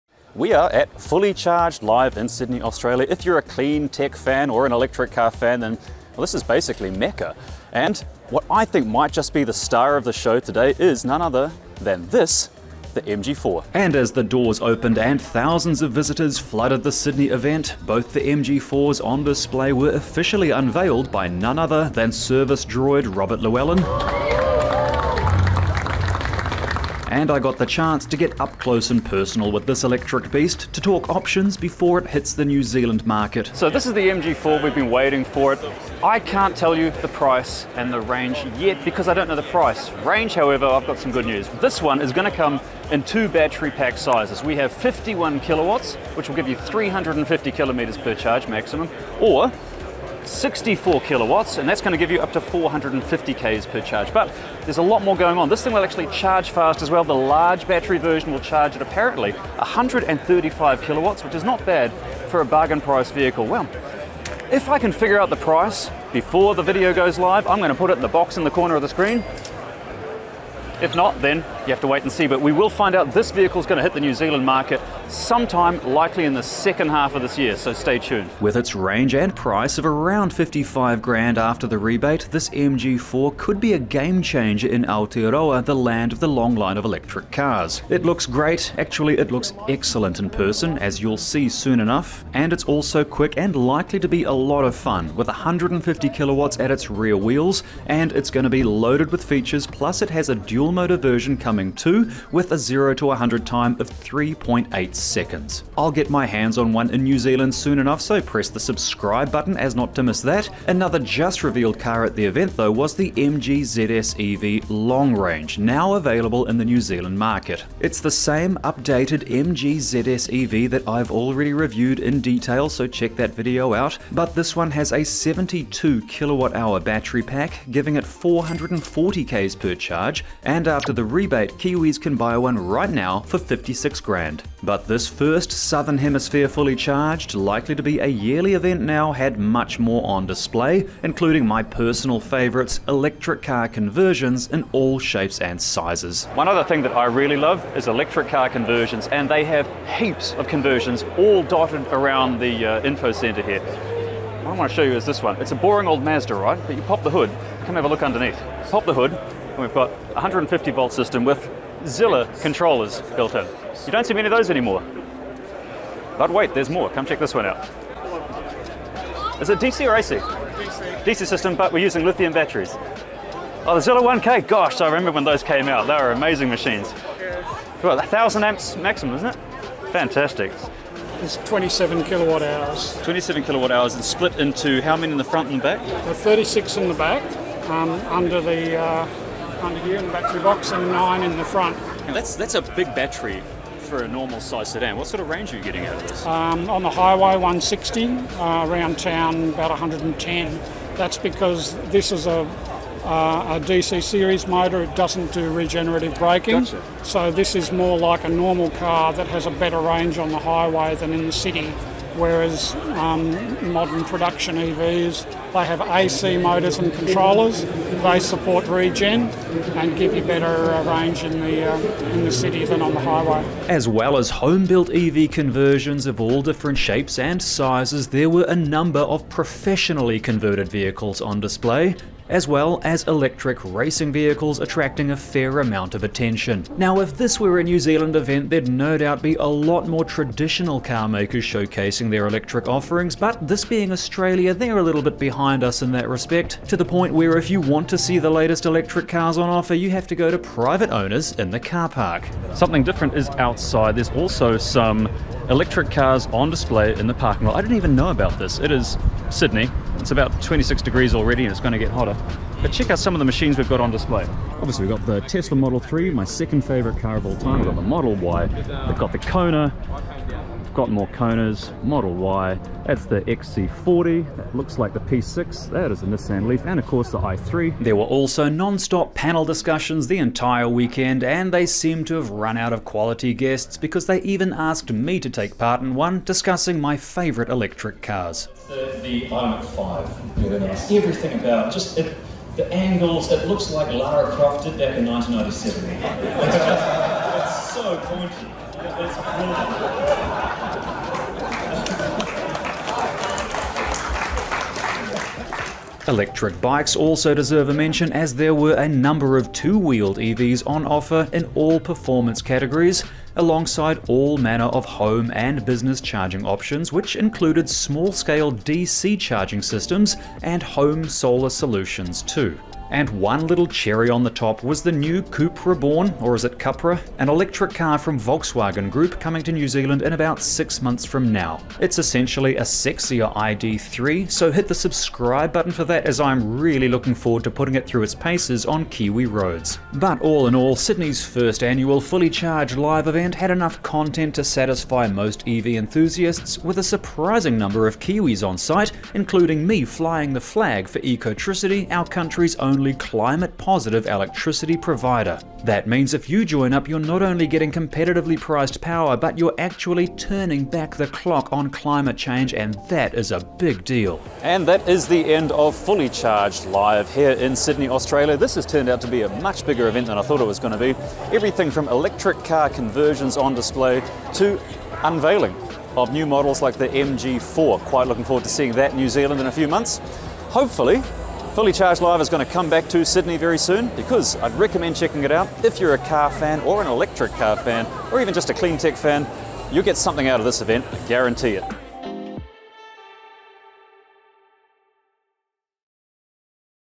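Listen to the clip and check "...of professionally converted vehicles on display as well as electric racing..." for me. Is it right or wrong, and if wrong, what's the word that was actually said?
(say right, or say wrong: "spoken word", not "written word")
right.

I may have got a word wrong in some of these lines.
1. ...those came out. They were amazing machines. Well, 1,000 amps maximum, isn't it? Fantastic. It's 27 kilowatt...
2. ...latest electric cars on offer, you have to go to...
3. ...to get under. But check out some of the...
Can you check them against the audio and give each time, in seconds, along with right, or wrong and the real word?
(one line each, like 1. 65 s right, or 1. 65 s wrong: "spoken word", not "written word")
1. 175 s right
2. 248 s right
3. 261 s wrong: "hotter", not "under".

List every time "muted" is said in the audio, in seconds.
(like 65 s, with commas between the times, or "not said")
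not said.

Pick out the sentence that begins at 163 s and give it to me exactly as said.
You don't see many of those anymore.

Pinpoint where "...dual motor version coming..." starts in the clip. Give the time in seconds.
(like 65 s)
100 s.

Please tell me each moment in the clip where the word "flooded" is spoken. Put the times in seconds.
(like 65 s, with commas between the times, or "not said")
16 s.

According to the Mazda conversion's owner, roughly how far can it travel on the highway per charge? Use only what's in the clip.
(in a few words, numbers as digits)
160.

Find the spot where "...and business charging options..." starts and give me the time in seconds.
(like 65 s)
315 s.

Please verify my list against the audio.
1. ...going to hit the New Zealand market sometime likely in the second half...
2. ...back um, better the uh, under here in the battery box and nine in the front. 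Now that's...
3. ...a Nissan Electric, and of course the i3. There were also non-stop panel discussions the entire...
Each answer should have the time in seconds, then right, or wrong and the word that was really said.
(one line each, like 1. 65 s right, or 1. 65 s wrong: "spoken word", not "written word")
1. 73 s right
2. 186 s wrong: "under", not "better"
3. 276 s wrong: "Leaf", not "Electric".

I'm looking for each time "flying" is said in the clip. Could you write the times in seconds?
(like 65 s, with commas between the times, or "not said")
349 s.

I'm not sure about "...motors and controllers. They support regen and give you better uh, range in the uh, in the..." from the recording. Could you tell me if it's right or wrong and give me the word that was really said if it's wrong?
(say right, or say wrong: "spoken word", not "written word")
right.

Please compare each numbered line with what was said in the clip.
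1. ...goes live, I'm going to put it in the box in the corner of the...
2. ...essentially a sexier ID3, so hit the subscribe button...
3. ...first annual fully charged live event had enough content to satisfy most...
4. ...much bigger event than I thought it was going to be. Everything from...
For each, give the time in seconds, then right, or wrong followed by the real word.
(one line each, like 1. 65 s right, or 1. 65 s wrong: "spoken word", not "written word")
1. 66 s right
2. 331 s right
3. 341 s right
4. 369 s right.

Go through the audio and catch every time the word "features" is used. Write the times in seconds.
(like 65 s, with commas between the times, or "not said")
99 s.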